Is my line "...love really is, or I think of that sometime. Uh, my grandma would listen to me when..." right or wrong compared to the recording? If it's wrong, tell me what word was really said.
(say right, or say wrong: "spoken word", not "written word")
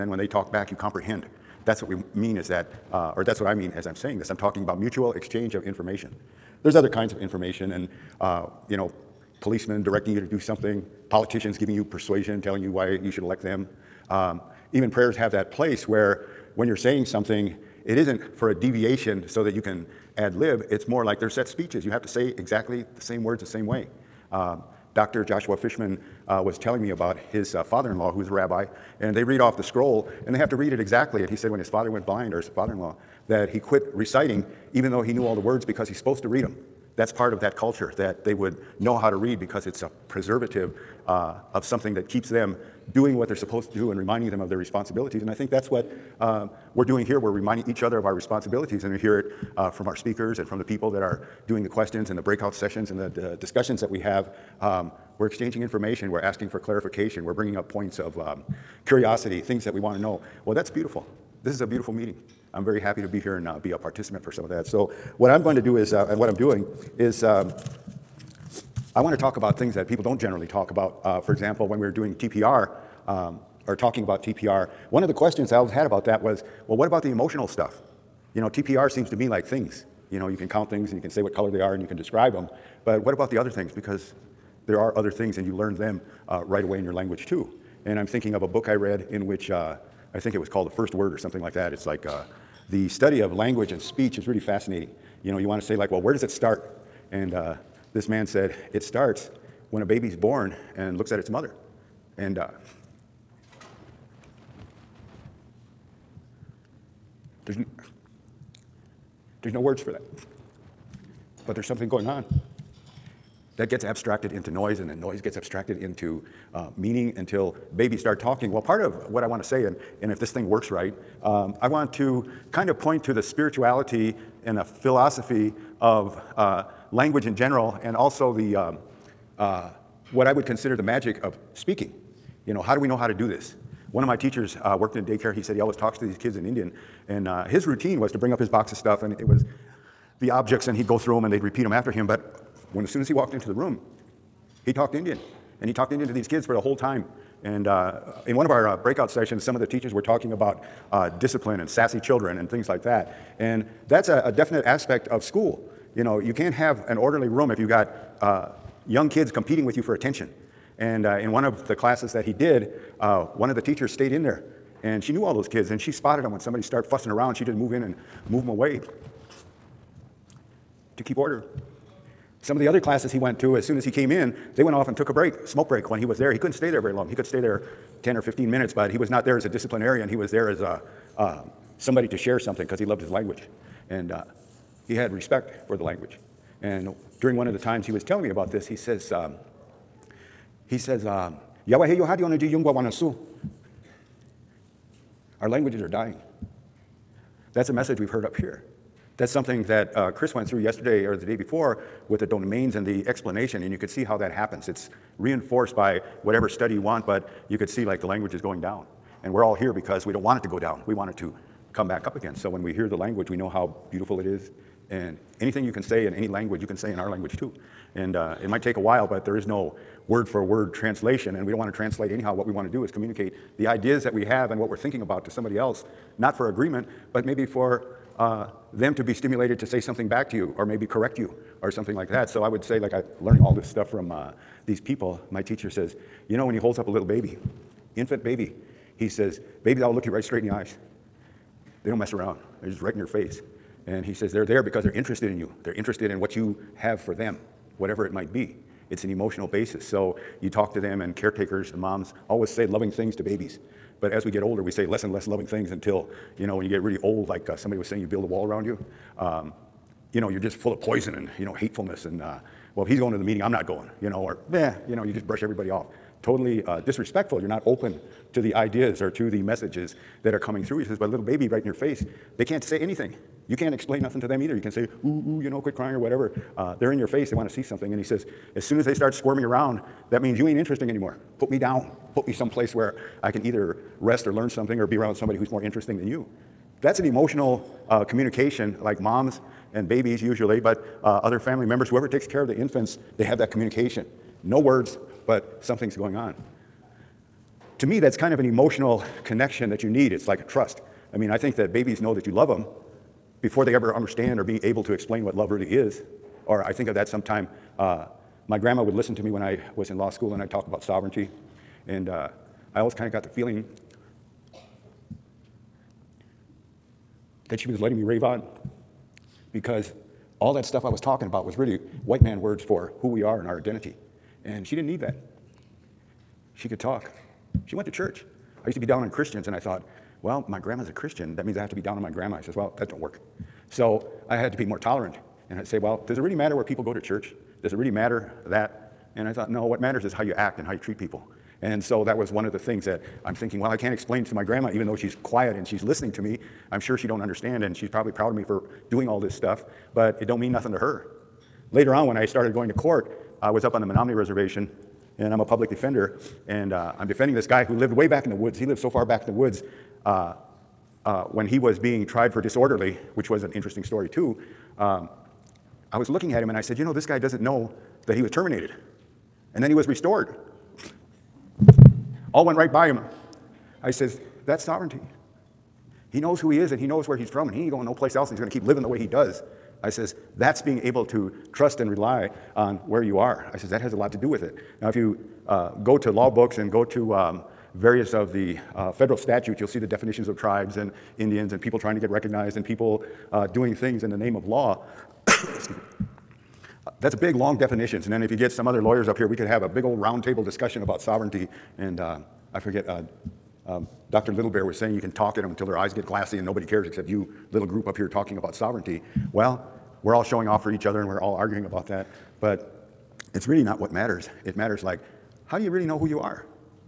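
right.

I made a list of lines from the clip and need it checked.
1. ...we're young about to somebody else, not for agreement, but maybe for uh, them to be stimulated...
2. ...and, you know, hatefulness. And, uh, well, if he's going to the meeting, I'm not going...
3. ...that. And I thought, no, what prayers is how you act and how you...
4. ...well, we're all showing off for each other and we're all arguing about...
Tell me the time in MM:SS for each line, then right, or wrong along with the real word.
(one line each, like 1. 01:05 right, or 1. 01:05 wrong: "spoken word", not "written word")
1. 03:44 wrong: "thinking", not "young"
2. 04:21 right
3. 05:38 wrong: "matters", not "prayers"
4. 06:49 right.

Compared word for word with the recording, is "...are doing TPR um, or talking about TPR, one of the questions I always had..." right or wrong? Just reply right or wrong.
right.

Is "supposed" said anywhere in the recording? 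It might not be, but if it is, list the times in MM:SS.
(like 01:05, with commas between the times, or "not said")
00:35, 00:43.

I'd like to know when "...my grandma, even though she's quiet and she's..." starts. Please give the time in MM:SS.
05:44.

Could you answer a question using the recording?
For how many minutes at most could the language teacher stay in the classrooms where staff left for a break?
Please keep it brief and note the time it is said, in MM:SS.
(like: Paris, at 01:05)
10 or 15, at 02:58.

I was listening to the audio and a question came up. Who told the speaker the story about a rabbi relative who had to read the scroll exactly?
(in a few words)
Dr. Joshua Fishman.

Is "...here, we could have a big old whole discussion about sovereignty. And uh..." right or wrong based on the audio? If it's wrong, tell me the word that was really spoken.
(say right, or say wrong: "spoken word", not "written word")
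wrong: "roundtable", not "whole".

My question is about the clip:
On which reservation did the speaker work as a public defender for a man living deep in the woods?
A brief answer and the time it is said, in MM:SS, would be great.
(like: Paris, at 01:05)
Menominee, at 05:53.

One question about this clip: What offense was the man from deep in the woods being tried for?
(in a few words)
Disorderly.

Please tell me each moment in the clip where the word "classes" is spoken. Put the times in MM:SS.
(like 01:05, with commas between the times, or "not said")
02:41, 02:52.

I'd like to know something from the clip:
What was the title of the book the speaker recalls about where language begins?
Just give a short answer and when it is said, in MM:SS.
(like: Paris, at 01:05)
The First Word, at 01:30.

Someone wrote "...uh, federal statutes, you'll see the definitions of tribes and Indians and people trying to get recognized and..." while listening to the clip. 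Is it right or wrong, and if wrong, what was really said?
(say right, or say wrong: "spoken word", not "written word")
right.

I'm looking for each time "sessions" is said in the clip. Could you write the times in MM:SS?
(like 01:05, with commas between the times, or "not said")
00:52, 02:29.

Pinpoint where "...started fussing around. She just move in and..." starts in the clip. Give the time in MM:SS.
02:46.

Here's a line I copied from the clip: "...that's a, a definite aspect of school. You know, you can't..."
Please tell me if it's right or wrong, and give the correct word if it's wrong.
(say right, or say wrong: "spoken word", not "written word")
right.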